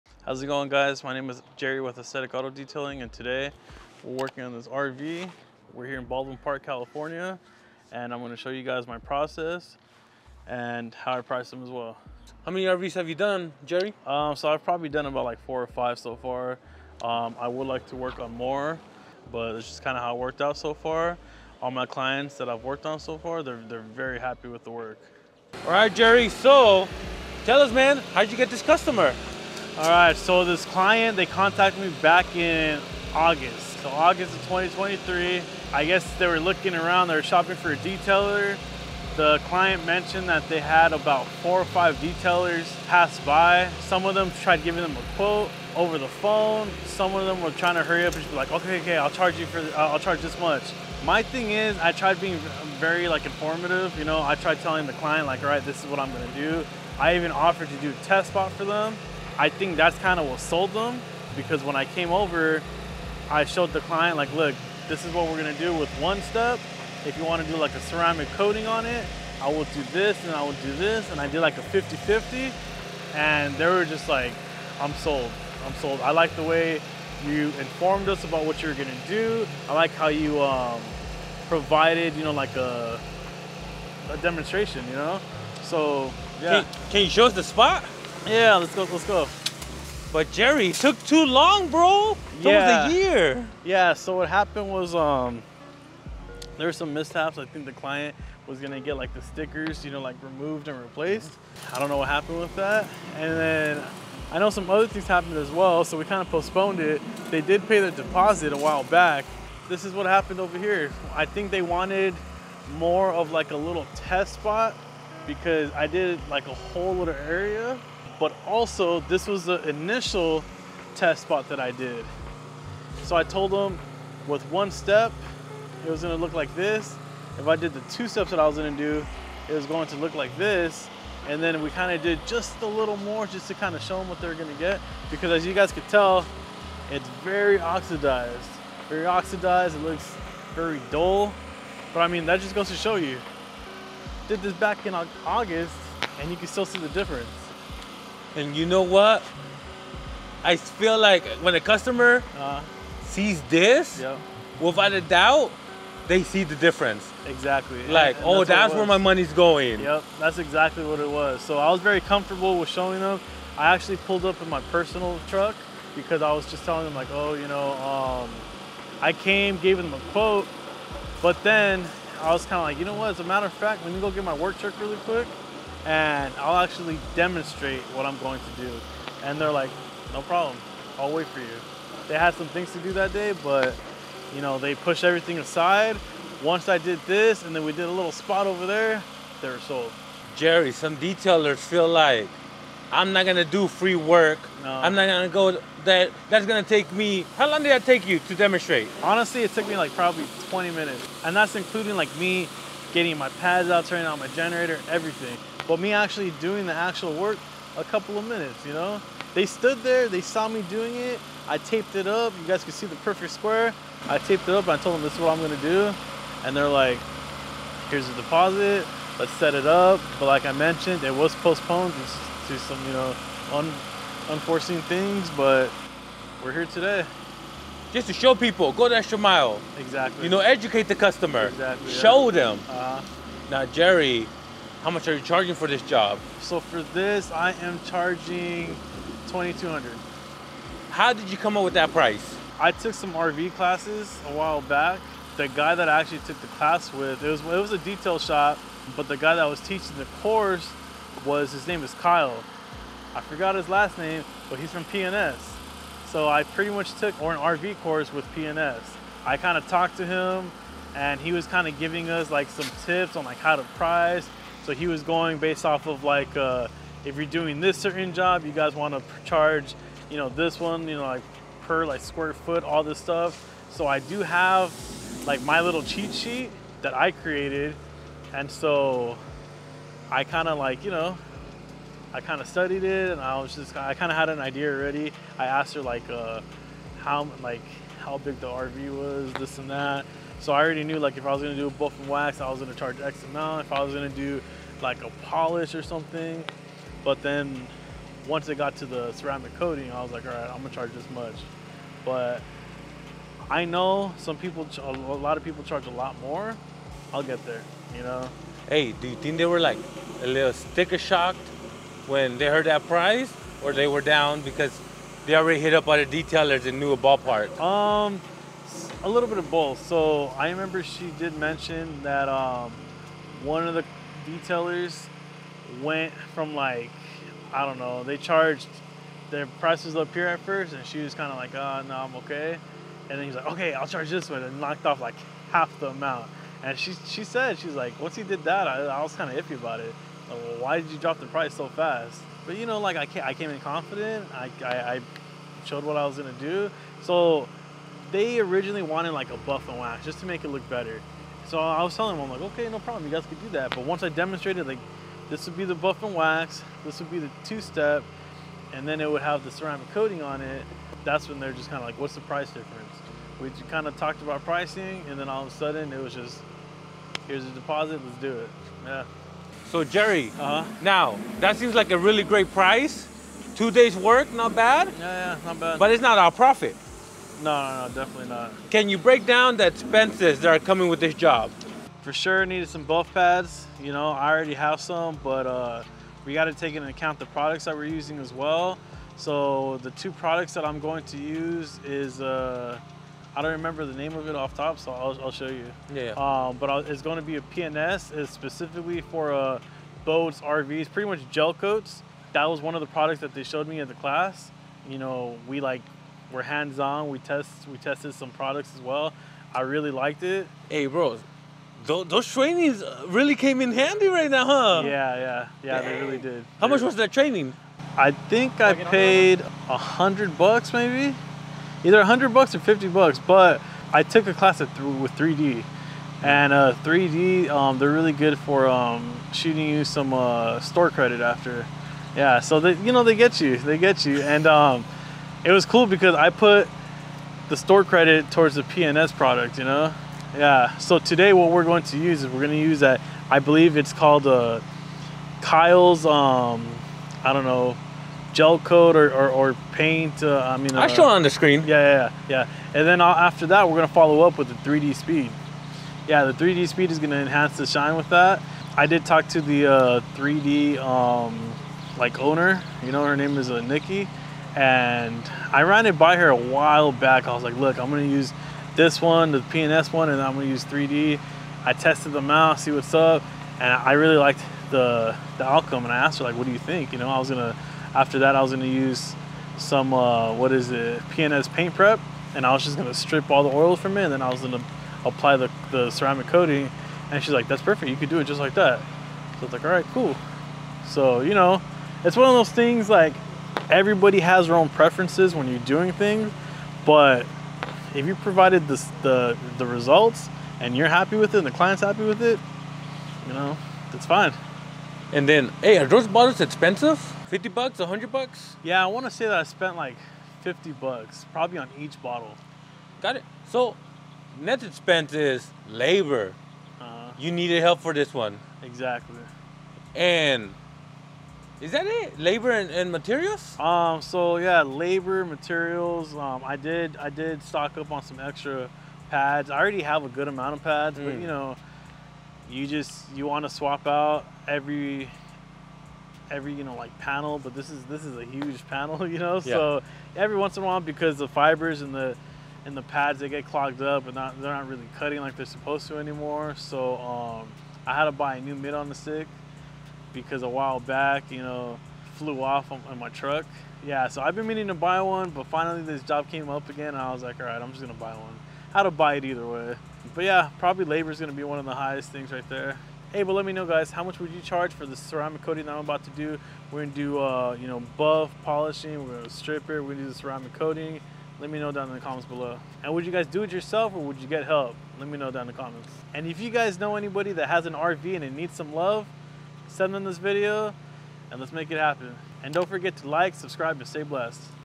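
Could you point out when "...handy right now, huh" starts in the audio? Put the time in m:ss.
6:53.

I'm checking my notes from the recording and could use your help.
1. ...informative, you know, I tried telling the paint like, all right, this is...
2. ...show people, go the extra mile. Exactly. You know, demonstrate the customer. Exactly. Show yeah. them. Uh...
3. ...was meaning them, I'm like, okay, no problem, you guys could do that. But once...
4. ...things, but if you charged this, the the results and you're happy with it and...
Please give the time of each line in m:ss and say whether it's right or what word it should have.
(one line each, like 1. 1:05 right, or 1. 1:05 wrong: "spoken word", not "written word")
1. 0:53 wrong: "client", not "paint"
2. 3:48 wrong: "educate", not "demonstrate"
3. 5:51 wrong: "telling", not "meaning"
4. 8:15 wrong: "provided", not "charged".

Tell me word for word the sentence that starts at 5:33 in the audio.
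And then he's like, okay, I'll charge this one, and knocked off like half the amount.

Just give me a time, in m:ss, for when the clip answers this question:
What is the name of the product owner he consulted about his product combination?
7:43.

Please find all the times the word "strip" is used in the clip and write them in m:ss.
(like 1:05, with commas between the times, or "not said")
8:02, 9:29.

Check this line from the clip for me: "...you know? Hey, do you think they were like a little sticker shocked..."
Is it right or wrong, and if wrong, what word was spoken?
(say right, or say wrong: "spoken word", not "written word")
right.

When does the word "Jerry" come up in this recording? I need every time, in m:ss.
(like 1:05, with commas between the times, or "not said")
0:01, 0:13, 0:25, 1:30, 3:10, 3:53, 6:09.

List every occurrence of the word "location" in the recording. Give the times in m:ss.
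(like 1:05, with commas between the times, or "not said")
not said.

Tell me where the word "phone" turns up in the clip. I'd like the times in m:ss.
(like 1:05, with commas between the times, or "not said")
0:46.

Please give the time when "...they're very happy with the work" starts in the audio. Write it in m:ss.
0:23.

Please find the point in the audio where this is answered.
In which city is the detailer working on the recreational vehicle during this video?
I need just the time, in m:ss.
0:06.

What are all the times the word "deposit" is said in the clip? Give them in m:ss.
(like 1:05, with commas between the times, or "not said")
1:47, 3:38, 6:07.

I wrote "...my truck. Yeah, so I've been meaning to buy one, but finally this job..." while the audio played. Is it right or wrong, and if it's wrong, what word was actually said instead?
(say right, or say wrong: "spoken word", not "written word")
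right.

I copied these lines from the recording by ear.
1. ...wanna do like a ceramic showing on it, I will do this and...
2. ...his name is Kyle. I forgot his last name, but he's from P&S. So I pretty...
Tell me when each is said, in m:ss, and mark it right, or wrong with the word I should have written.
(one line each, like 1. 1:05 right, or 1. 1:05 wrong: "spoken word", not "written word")
1. 1:07 wrong: "coating", not "showing"
2. 4:11 right.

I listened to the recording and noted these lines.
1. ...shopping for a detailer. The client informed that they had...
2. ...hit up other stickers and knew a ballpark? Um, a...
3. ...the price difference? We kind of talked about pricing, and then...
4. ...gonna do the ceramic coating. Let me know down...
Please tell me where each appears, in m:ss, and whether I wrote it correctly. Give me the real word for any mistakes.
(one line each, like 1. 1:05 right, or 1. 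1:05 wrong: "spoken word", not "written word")
1. 0:37 wrong: "mentioned", not "informed"
2. 5:15 wrong: "detailers", not "stickers"
3. 6:02 right
4. 9:29 right.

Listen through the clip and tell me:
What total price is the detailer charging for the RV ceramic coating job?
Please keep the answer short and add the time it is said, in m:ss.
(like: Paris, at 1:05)
2200, at 3:59.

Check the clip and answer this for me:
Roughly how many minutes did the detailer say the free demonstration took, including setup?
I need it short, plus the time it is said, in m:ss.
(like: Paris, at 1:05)
20 minutes, at 3:20.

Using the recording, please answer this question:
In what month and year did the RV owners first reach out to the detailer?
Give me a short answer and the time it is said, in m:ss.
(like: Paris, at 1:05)
August 2023, at 0:33.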